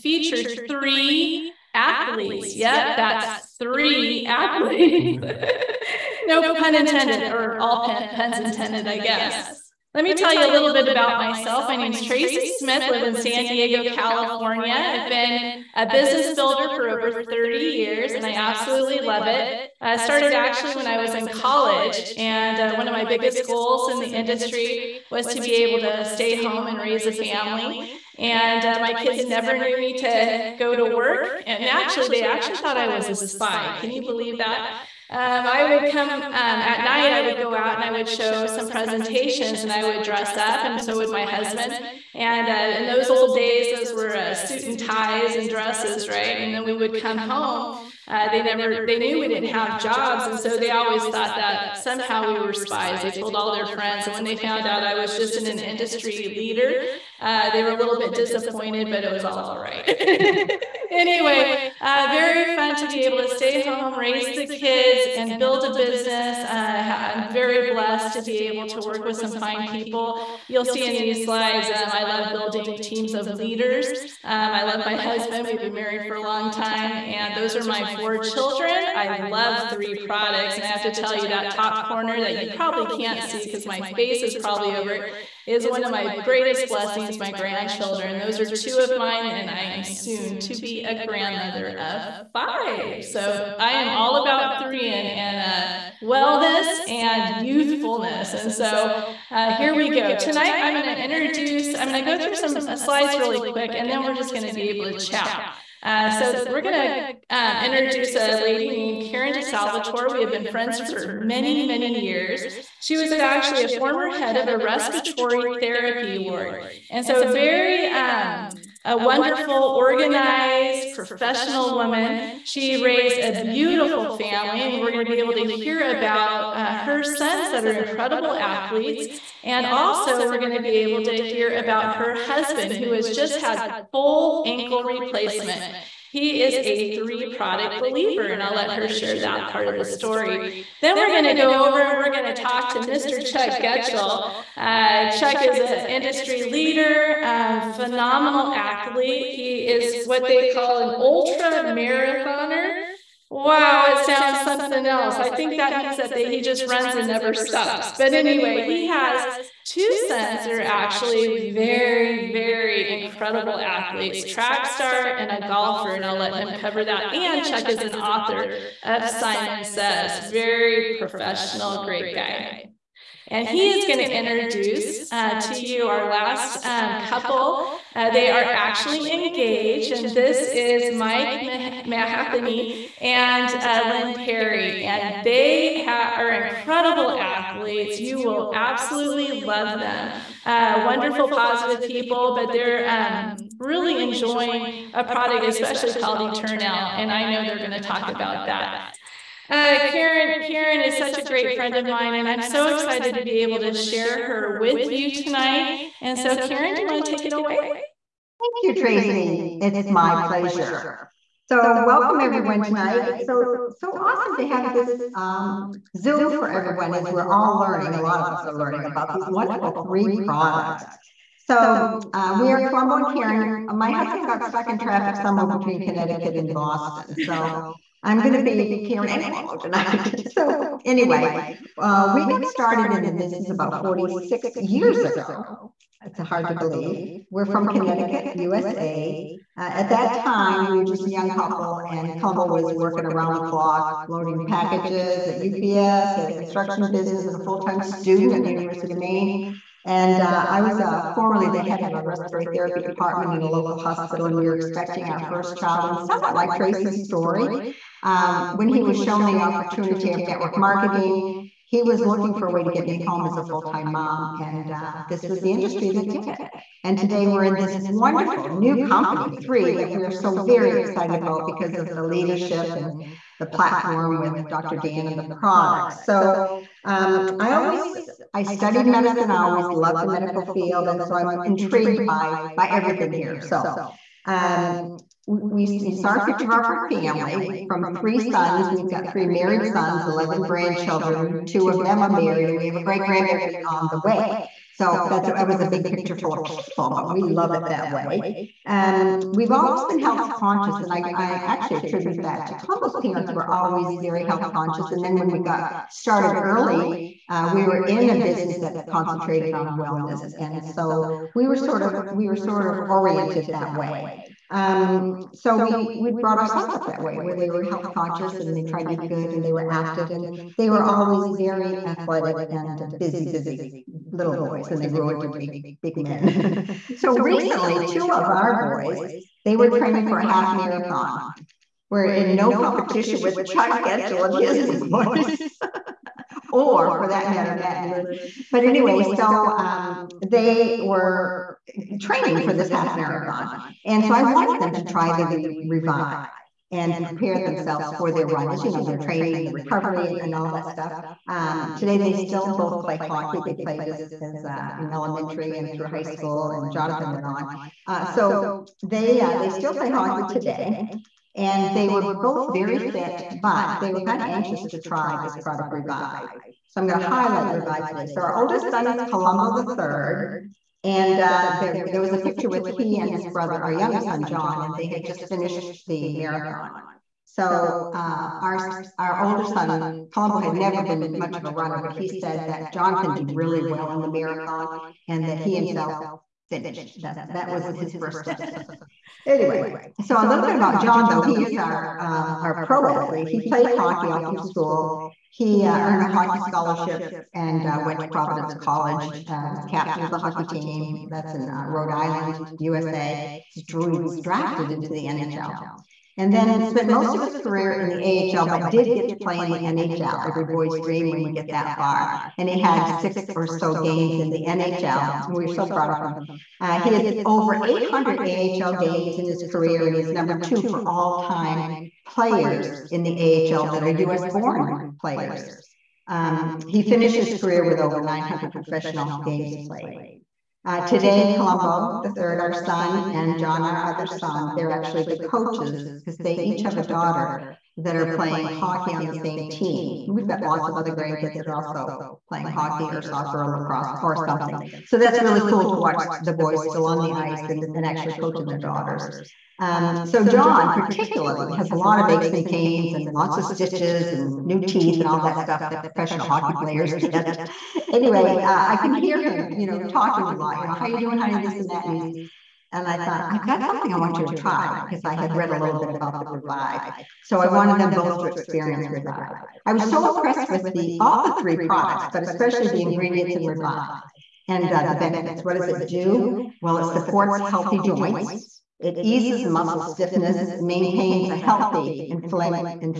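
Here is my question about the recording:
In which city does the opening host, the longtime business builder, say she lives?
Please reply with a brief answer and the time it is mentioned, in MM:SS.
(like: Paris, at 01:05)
San Diego, at 00:13.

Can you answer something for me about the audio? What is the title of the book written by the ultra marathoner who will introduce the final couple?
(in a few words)
Simon Says.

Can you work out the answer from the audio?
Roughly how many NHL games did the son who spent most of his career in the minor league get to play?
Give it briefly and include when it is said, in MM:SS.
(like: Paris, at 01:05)
6, at 06:52.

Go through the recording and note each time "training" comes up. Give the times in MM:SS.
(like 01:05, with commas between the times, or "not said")
05:29, 05:41, 05:48.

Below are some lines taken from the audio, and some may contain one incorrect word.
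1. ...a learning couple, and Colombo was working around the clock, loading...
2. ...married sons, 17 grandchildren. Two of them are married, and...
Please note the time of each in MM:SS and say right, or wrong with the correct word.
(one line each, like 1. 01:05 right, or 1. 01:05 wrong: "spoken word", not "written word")
1. 04:01 wrong: "young", not "learning"
2. 04:49 wrong: "11", not "17".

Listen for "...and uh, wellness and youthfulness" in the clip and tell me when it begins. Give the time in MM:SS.
01:35.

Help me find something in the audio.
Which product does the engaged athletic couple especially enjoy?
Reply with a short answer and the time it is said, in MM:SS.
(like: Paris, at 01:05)
Eternal, at 03:16.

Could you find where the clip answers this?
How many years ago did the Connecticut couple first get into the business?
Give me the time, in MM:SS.
03:53.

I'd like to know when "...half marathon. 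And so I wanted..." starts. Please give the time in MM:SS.
05:42.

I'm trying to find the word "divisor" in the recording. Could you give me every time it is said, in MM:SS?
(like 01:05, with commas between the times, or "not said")
not said.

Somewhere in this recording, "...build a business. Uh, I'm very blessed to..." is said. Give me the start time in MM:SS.
01:05.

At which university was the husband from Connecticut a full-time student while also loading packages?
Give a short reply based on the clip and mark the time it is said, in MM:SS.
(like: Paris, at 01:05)
University of Maine, at 04:08.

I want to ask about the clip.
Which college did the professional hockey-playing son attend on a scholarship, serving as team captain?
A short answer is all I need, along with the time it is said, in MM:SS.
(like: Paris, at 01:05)
Providence College, at 06:38.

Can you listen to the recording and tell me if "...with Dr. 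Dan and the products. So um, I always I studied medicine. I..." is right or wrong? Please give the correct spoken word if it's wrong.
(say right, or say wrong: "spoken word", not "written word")
right.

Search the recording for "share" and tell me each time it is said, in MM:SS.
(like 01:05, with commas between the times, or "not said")
02:18, 03:23.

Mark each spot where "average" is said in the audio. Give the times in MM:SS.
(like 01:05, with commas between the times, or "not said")
not said.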